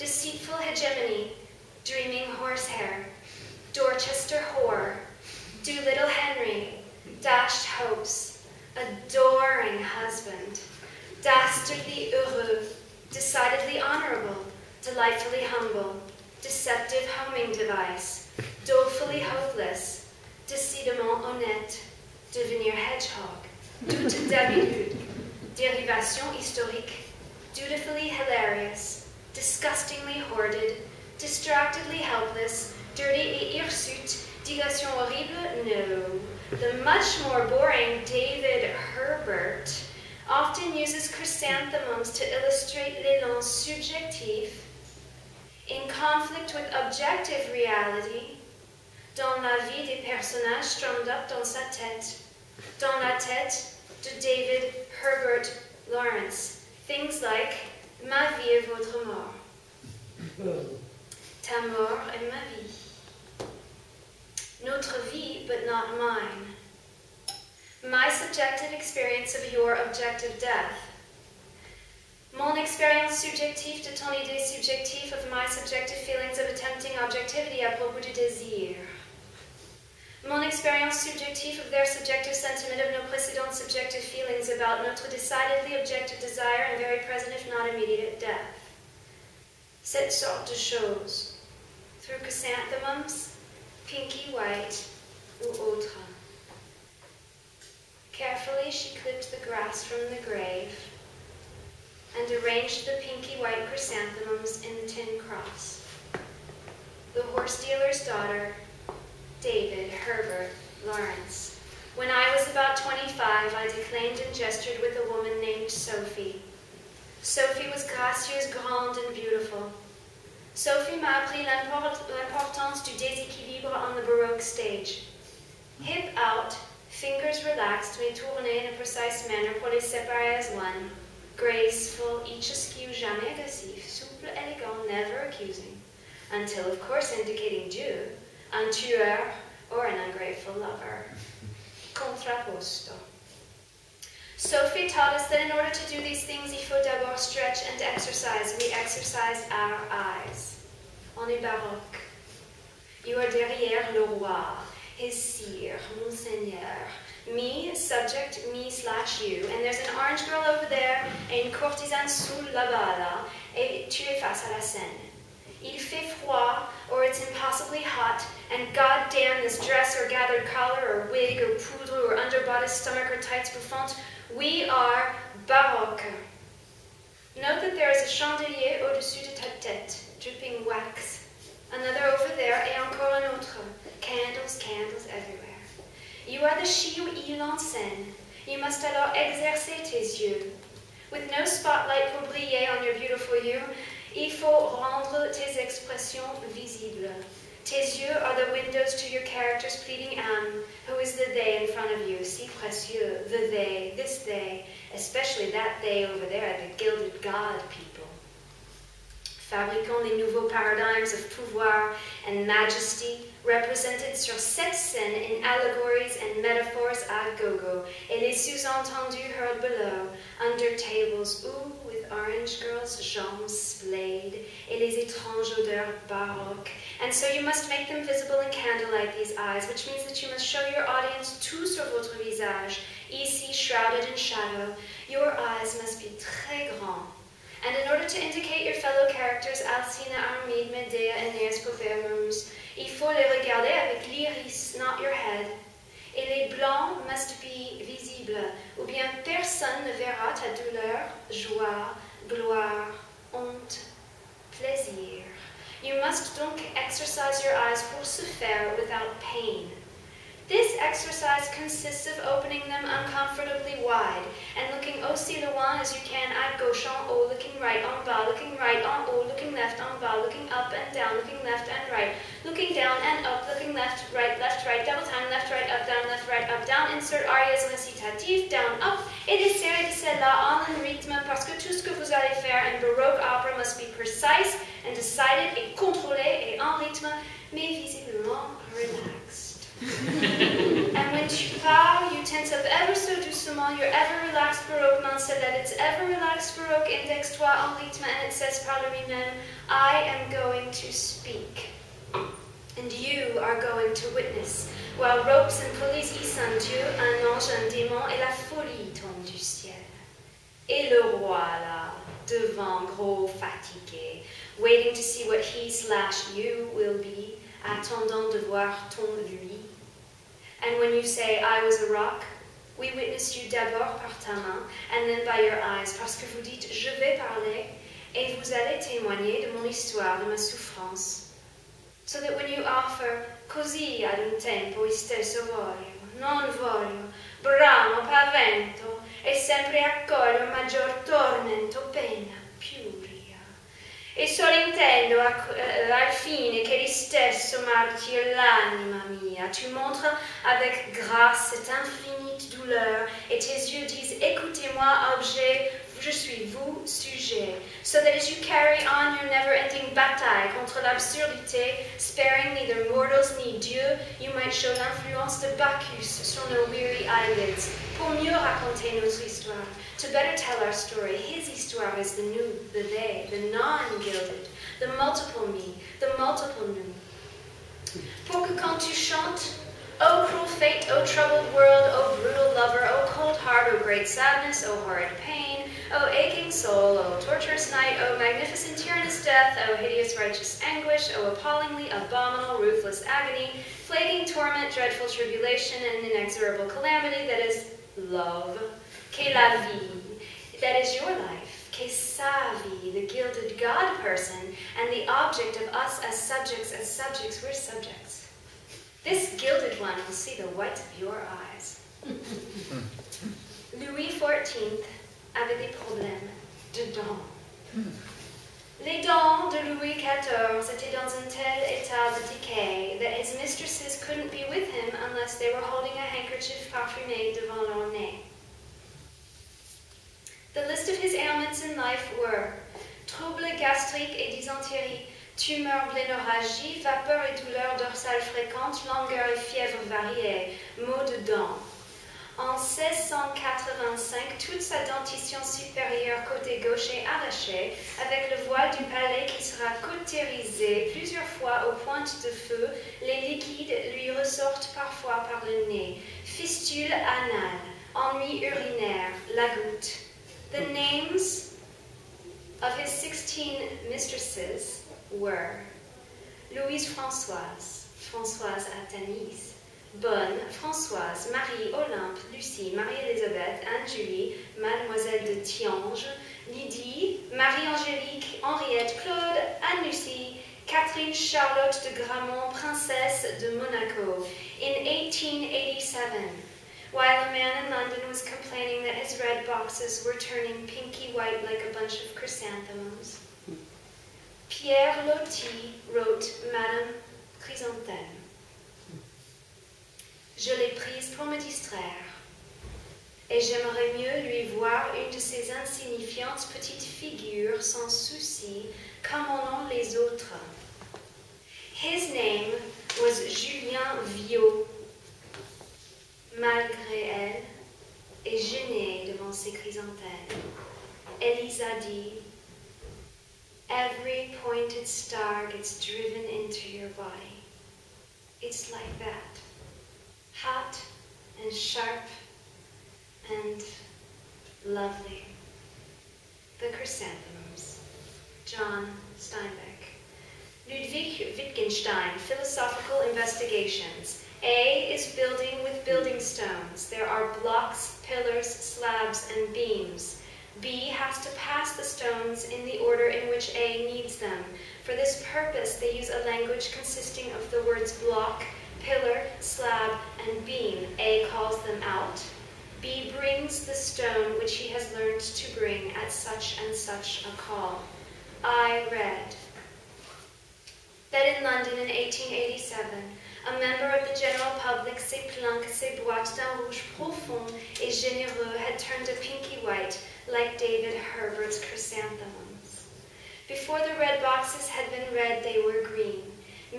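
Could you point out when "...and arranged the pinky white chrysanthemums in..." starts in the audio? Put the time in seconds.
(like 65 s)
102 s.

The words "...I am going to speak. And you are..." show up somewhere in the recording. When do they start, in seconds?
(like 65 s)
299 s.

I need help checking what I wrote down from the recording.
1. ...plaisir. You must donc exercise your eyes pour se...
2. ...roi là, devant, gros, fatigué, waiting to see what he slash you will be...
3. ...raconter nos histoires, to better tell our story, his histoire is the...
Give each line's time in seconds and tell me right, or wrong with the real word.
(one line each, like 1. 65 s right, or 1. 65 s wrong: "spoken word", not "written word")
1. 254 s right
2. 311 s right
3. 368 s right.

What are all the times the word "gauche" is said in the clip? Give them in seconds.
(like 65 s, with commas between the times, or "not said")
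266 s, 446 s.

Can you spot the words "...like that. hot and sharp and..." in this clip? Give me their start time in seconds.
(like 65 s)
528 s.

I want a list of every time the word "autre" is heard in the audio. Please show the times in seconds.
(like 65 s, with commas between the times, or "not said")
95 s, 183 s, 509 s.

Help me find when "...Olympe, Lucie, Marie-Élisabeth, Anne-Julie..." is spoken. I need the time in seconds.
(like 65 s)
471 s.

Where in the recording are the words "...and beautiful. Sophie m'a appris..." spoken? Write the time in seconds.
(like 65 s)
118 s.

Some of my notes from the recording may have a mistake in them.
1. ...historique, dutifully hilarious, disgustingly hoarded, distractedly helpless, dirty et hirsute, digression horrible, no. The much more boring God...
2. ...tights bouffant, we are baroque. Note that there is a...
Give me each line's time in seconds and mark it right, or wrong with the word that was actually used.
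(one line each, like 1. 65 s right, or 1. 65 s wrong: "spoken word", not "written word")
1. 26 s wrong: "David", not "God"
2. 173 s right.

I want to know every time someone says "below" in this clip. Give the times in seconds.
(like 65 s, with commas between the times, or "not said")
219 s.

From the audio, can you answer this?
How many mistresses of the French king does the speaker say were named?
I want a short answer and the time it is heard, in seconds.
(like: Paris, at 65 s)
16, at 462 s.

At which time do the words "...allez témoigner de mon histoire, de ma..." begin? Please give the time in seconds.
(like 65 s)
328 s.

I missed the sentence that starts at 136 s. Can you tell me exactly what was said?
Until, of course, indicating due, un tueur or an ungrateful lover.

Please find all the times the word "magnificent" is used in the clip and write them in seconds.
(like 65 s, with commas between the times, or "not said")
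388 s.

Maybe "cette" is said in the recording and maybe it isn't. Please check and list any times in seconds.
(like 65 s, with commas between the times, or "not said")
89 s, 214 s, 351 s.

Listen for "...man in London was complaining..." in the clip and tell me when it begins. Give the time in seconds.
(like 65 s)
487 s.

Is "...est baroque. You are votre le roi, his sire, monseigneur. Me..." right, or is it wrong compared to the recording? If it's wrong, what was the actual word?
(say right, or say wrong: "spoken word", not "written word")
wrong: "derrière", not "votre".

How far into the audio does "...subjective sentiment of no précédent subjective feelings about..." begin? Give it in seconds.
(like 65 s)
81 s.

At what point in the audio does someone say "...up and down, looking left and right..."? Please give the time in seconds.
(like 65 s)
270 s.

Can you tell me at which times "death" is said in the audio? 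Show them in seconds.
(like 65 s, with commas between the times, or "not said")
70 s, 88 s, 389 s.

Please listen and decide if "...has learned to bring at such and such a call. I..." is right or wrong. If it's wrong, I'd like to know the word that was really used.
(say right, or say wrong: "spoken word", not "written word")
right.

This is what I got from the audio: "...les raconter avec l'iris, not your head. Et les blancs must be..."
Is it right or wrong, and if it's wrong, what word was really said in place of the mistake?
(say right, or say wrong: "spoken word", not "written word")
wrong: "regarder", not "raconter".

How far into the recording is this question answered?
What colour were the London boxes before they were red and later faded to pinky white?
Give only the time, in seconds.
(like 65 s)
585 s.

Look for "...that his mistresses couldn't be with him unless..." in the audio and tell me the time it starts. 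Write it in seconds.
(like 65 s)
423 s.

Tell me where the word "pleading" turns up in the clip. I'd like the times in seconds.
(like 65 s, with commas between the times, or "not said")
199 s.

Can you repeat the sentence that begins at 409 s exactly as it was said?
This gilded one will see the white of your eyes.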